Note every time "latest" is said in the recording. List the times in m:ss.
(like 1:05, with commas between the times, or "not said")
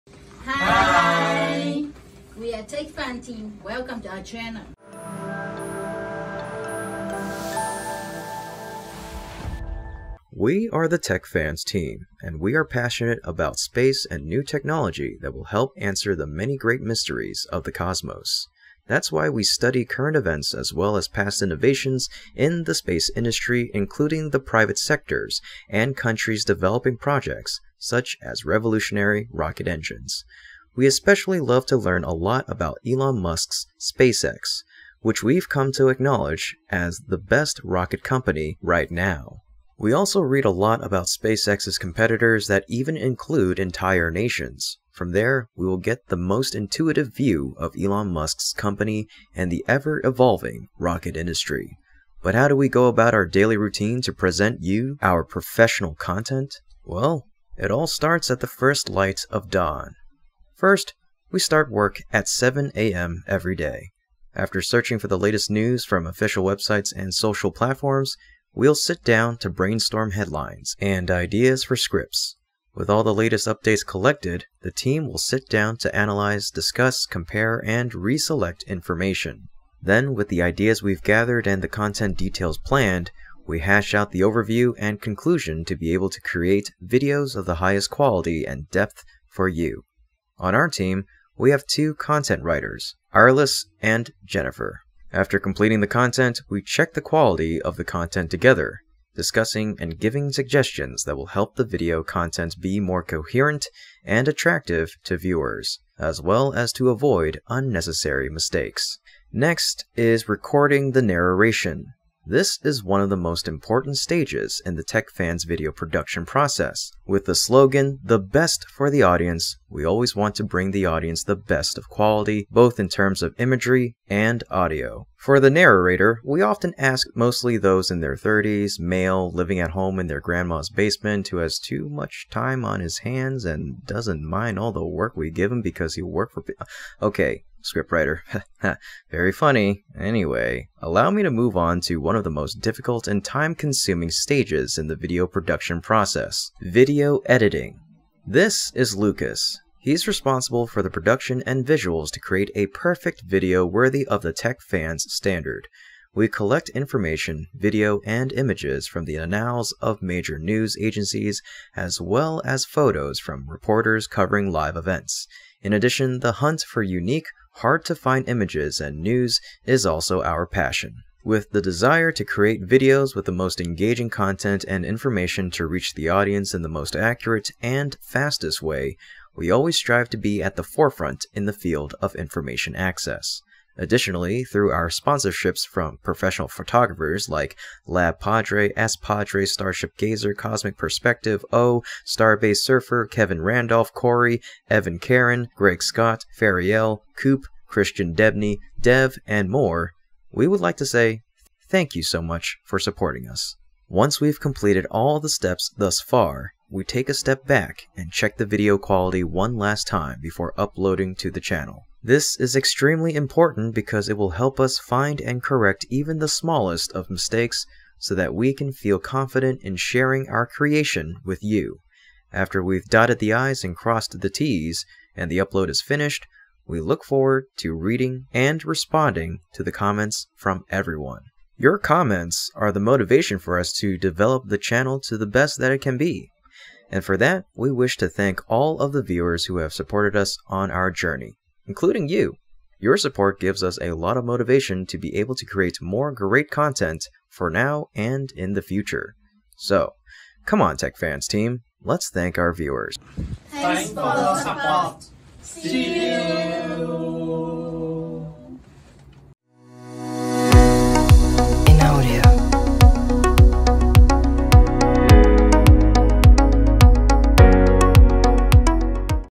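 1:05, 1:13.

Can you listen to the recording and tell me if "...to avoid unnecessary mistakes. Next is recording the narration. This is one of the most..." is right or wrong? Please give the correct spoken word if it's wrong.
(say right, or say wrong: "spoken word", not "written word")
right.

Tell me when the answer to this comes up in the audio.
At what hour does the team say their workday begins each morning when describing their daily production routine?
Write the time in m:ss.
1:02.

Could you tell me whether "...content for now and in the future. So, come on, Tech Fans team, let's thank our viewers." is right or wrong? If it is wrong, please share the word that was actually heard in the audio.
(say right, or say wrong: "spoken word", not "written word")
right.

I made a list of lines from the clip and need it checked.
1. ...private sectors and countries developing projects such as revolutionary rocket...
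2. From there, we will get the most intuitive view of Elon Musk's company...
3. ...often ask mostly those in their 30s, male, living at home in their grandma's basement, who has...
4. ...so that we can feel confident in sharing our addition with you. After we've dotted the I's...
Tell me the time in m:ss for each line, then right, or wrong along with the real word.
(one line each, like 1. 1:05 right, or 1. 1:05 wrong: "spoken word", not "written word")
1. 0:24 right
2. 0:44 right
3. 2:06 right
4. 3:37 wrong: "creation", not "addition".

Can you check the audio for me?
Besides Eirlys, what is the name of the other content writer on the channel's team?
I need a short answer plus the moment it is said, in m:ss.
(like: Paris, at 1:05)
Jennifer, at 1:34.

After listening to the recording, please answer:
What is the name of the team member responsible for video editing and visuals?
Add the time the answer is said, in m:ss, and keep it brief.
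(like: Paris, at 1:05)
Lucas, at 2:28.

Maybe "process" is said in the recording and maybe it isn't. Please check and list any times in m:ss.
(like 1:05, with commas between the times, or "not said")
1:56, 2:25.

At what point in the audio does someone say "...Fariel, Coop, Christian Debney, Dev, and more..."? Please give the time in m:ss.
3:16.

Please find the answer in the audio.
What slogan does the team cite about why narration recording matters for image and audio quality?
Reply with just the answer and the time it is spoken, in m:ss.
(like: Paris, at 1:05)
the best for the audience, at 1:58.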